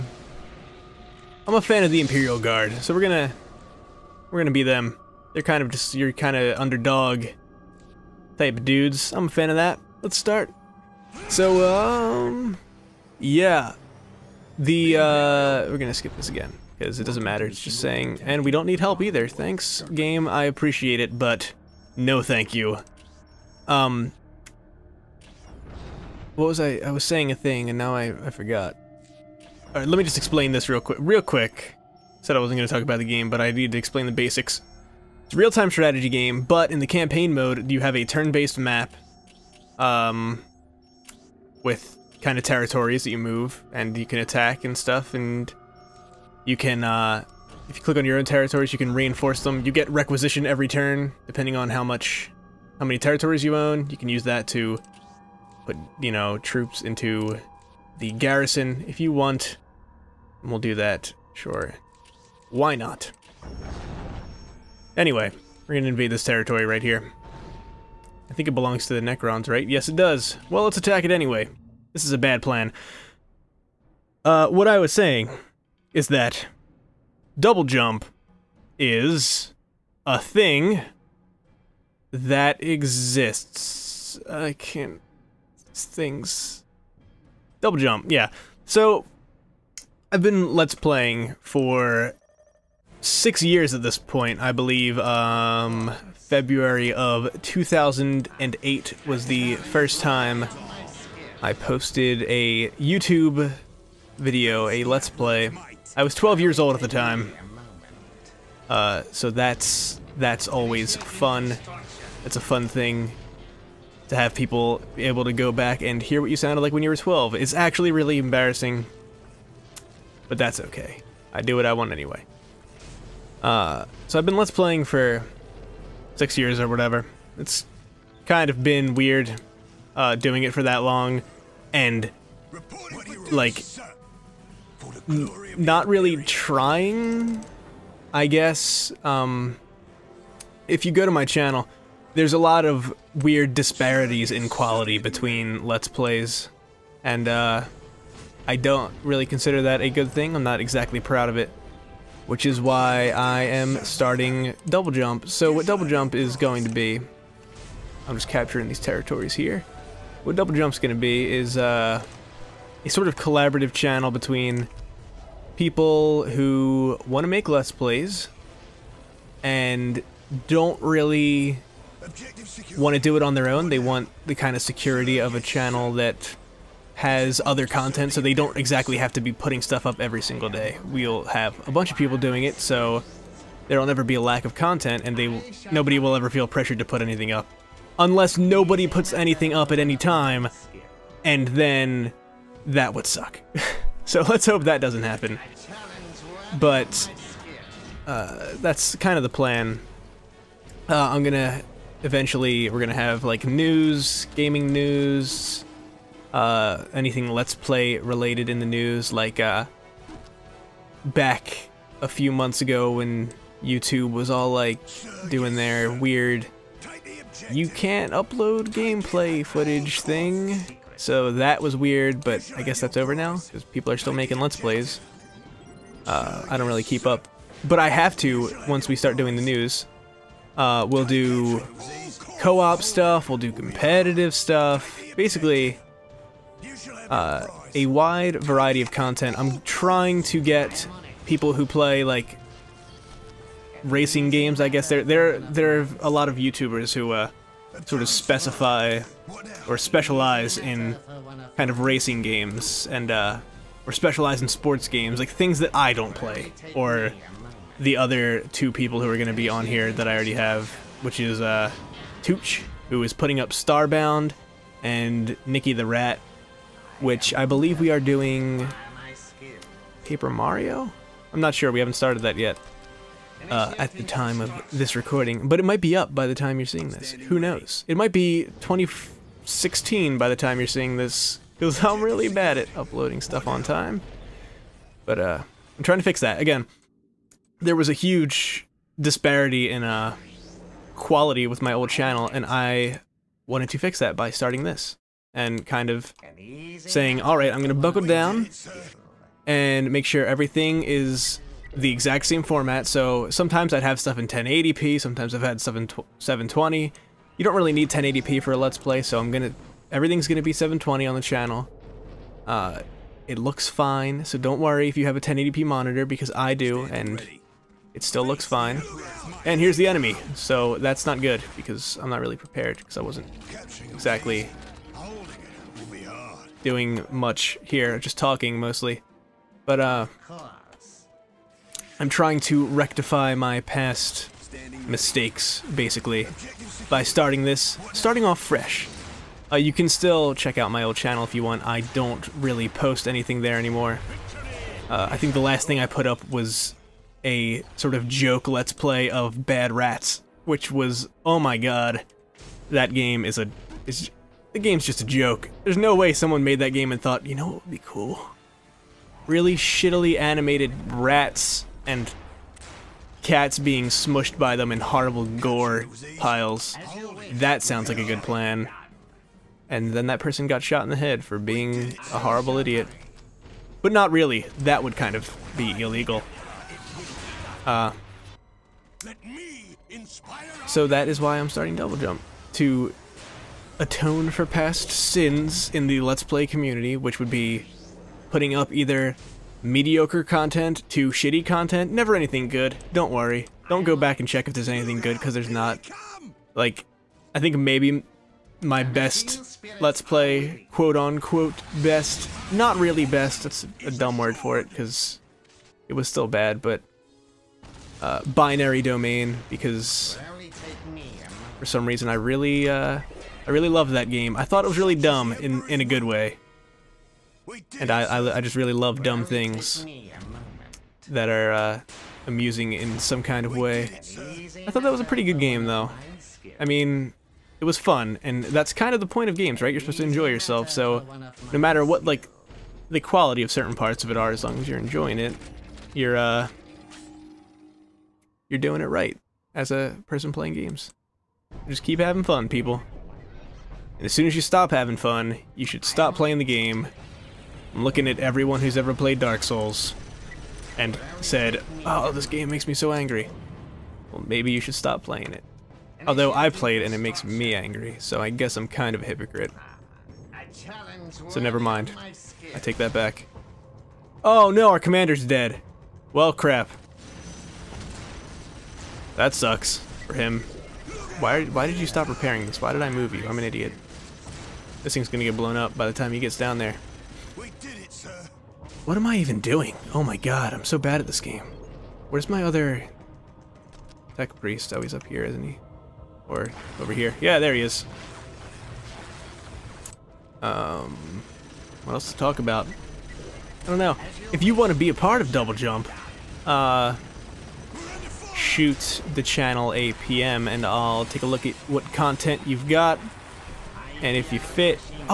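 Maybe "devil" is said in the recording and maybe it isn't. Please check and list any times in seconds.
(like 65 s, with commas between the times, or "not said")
not said.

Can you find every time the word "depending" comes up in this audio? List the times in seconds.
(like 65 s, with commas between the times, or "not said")
51 s.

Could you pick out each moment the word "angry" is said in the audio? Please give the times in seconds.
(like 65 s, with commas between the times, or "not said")
452 s, 457 s.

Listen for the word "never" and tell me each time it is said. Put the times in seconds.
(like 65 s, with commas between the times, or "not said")
183 s, 391 s, 461 s.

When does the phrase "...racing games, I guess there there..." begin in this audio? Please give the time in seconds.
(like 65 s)
243 s.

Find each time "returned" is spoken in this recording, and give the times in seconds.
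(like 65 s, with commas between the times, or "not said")
not said.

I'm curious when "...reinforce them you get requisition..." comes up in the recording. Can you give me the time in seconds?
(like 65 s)
48 s.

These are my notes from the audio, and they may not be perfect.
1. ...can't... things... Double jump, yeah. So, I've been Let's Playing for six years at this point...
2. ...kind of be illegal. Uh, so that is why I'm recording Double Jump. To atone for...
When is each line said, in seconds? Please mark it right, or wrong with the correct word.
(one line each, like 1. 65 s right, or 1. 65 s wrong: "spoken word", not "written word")
1. 84 s right
2. 374 s wrong: "starting", not "recording".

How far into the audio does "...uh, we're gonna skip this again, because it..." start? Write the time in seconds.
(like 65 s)
14 s.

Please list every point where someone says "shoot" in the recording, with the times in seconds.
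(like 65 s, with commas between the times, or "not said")
498 s.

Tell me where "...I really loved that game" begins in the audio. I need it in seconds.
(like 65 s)
413 s.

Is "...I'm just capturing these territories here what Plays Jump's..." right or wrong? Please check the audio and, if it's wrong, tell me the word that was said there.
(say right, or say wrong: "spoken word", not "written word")
wrong: "Double", not "Plays".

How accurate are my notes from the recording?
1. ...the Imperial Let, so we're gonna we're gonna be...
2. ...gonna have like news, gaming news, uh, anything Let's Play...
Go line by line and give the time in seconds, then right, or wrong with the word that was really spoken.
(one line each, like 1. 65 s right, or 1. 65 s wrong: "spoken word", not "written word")
1. 1 s wrong: "Guard", not "Let"
2. 202 s right.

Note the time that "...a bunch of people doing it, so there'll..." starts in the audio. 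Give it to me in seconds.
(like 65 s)
181 s.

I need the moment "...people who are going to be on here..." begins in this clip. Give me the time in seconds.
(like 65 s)
258 s.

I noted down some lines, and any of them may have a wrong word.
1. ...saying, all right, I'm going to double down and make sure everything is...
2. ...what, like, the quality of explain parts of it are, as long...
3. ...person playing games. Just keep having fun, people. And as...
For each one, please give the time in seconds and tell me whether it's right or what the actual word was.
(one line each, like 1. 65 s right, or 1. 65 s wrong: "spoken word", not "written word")
1. 296 s wrong: "buckle", not "double"
2. 431 s wrong: "certain", not "explain"
3. 440 s right.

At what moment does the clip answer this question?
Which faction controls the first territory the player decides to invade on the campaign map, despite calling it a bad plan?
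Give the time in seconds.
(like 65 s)
69 s.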